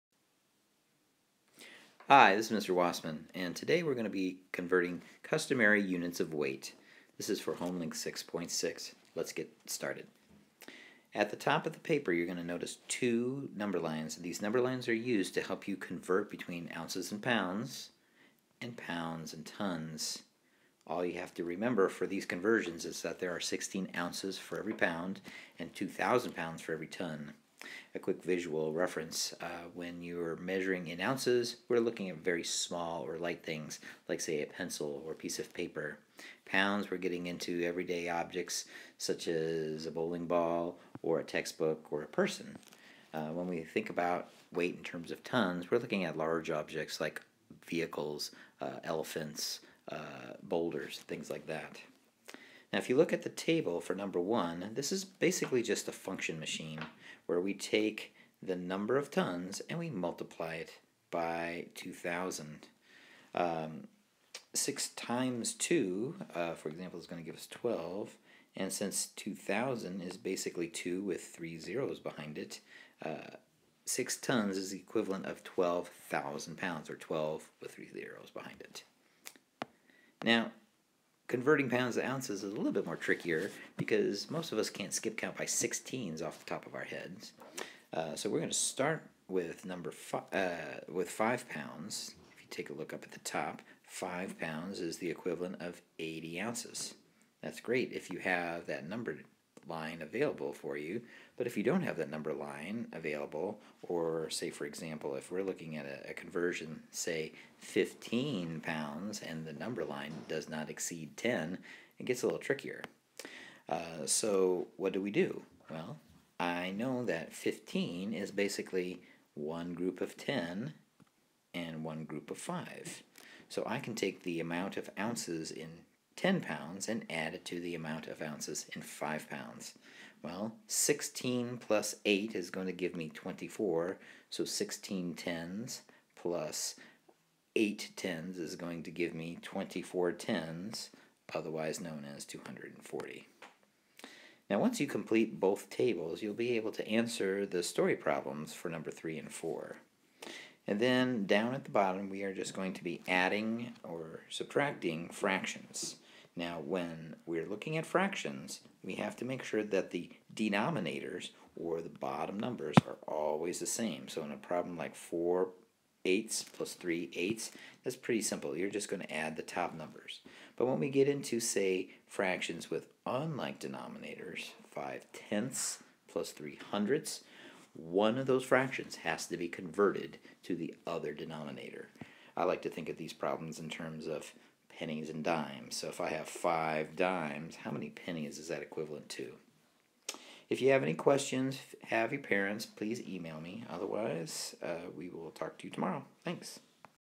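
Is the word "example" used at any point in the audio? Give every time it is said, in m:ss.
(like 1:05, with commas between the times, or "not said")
1:06, 1:44.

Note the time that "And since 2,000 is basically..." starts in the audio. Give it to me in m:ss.
1:08.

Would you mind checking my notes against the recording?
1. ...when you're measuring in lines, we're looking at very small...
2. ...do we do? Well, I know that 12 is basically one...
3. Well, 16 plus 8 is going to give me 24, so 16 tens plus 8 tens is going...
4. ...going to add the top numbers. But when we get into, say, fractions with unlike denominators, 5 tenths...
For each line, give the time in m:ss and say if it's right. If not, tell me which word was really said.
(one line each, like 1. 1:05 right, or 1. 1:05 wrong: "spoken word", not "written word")
1. 0:29 wrong: "ounces", not "lines"
2. 1:54 wrong: "15", not "12"
3. 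2:10 right
4. 2:48 right.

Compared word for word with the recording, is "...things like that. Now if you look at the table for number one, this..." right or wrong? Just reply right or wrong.
right.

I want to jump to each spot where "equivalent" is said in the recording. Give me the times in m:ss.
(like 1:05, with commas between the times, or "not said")
1:14, 1:35, 3:08.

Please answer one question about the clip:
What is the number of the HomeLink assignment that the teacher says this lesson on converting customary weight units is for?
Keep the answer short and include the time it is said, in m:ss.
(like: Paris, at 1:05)
6.6, at 0:07.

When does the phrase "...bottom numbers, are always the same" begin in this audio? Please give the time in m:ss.
2:41.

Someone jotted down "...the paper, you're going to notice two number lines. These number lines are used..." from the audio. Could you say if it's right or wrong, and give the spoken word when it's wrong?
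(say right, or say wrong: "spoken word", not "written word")
right.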